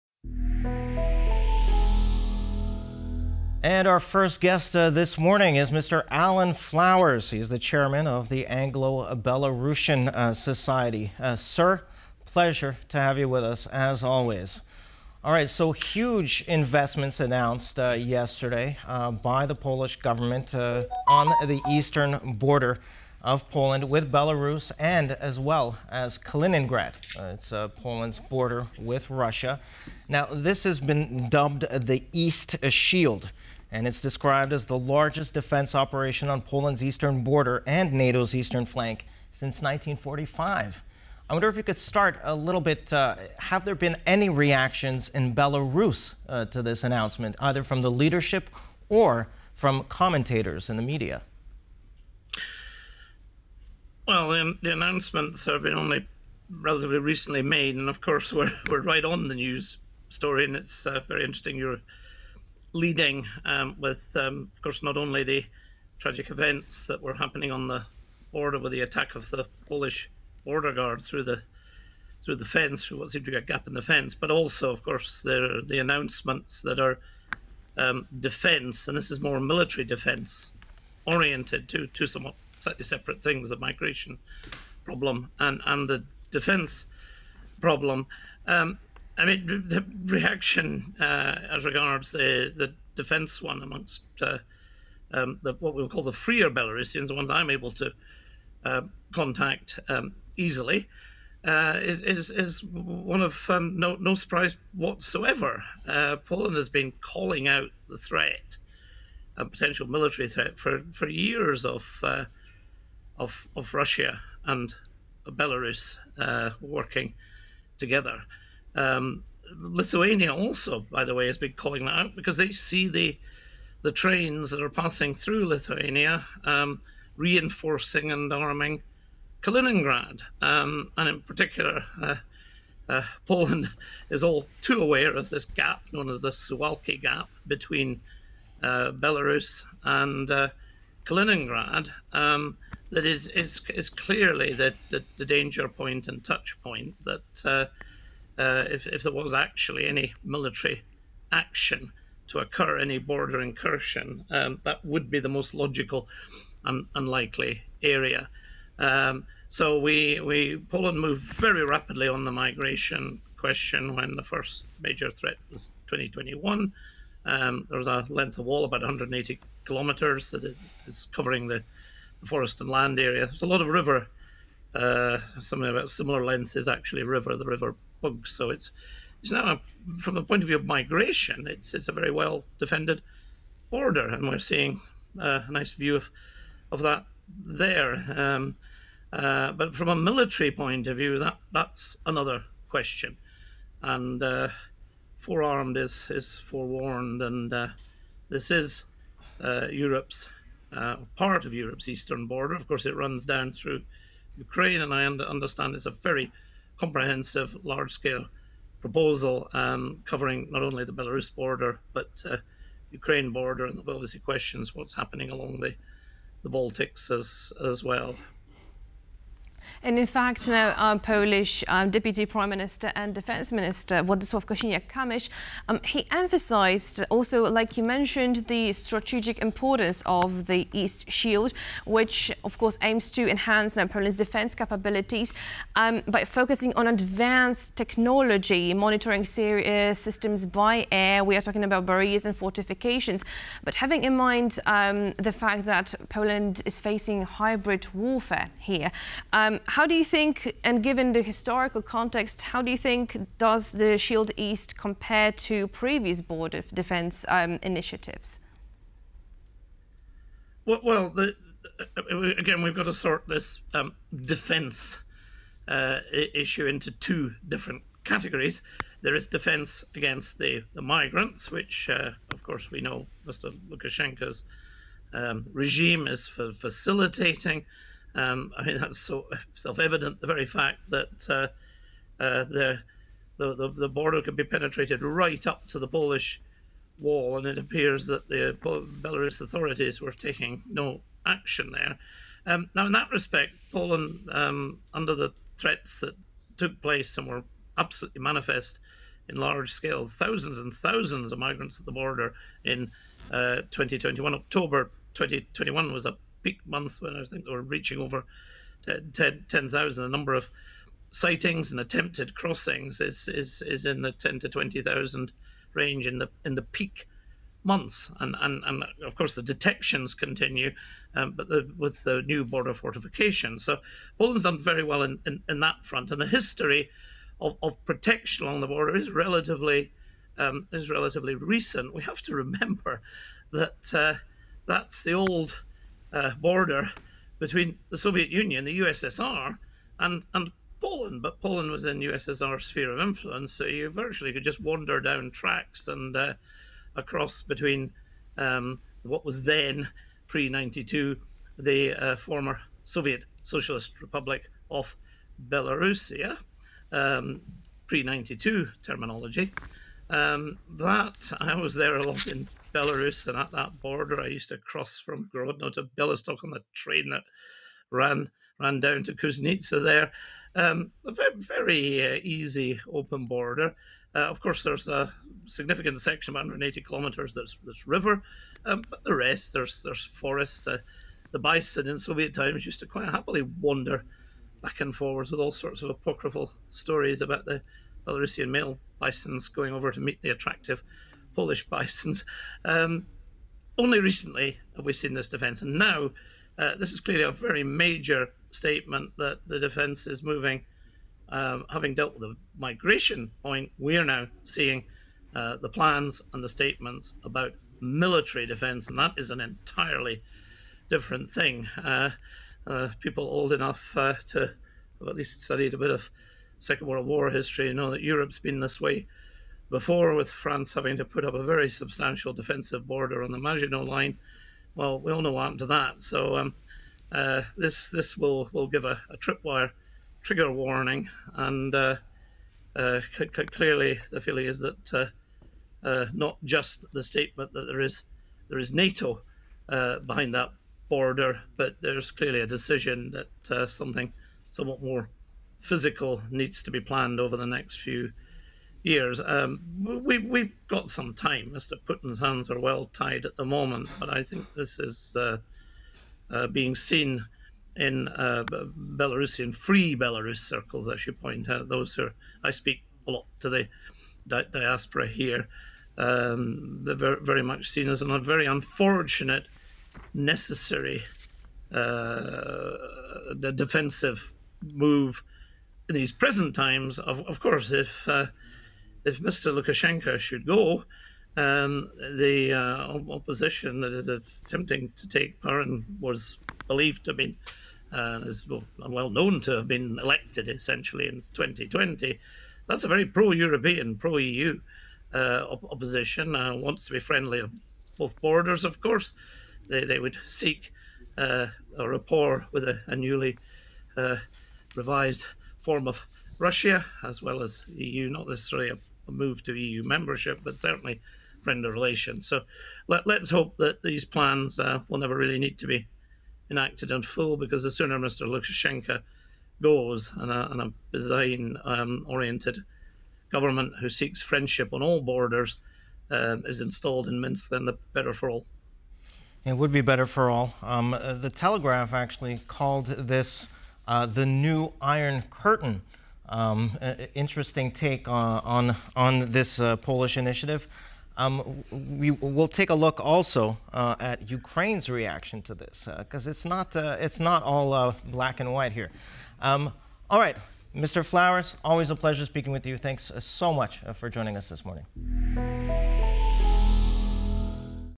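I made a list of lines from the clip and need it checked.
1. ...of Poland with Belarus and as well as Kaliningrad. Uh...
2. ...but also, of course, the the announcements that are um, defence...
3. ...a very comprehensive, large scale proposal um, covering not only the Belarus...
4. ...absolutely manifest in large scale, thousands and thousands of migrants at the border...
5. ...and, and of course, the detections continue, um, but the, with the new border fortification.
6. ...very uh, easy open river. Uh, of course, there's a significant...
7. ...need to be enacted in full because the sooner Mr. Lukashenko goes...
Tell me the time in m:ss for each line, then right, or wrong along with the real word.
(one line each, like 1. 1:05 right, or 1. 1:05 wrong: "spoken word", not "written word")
1. 0:23 right
2. 1:14 right
3. 3:25 right
4. 4:57 right
5. 5:18 right
6. 6:11 wrong: "border", not "river"
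7. 8:35 right.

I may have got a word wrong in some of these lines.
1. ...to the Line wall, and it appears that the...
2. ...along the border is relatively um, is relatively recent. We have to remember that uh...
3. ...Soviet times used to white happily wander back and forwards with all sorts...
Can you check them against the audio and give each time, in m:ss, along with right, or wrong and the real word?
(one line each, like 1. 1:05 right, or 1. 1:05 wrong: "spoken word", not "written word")
1. 4:45 wrong: "Polish", not "Line"
2. 5:28 right
3. 6:21 wrong: "quite", not "white".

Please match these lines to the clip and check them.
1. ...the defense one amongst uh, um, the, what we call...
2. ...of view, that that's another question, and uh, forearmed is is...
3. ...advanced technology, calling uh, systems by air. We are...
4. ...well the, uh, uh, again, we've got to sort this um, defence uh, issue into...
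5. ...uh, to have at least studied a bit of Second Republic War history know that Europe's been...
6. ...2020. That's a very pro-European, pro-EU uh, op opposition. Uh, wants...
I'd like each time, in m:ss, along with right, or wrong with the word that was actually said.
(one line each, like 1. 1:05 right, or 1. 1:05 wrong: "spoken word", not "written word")
1. 1:32 right
2. 3:10 right
3. 3:56 wrong: "monitoring", not "calling"
4. 4:20 right
5. 6:53 wrong: "World", not "Republic"
6. 8:11 right.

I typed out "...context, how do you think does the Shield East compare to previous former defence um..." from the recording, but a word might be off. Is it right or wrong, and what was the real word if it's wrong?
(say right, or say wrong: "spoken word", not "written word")
wrong: "border", not "former".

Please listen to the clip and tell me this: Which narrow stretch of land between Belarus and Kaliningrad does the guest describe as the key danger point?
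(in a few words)
Suwalki Gap.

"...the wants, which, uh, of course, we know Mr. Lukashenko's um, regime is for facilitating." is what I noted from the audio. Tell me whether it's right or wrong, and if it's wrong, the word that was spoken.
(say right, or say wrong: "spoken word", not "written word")
wrong: "migrants", not "wants".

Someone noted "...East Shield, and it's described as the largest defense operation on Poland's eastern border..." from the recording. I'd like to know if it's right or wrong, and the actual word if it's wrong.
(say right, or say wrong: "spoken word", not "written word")
right.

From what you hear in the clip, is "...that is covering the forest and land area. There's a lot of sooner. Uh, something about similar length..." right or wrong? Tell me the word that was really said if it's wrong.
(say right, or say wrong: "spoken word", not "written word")
wrong: "river", not "sooner".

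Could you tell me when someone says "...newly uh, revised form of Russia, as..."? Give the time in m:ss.
8:22.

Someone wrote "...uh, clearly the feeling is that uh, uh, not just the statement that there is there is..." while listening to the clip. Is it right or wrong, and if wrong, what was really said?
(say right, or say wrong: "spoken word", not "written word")
right.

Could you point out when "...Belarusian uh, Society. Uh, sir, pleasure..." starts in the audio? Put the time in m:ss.
0:09.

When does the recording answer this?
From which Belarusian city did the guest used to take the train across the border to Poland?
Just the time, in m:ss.
6:05.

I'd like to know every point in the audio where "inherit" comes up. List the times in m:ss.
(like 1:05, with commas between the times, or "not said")
not said.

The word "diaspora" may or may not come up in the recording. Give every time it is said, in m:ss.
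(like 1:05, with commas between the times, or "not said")
7:44.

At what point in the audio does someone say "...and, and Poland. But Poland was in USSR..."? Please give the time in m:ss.
5:39.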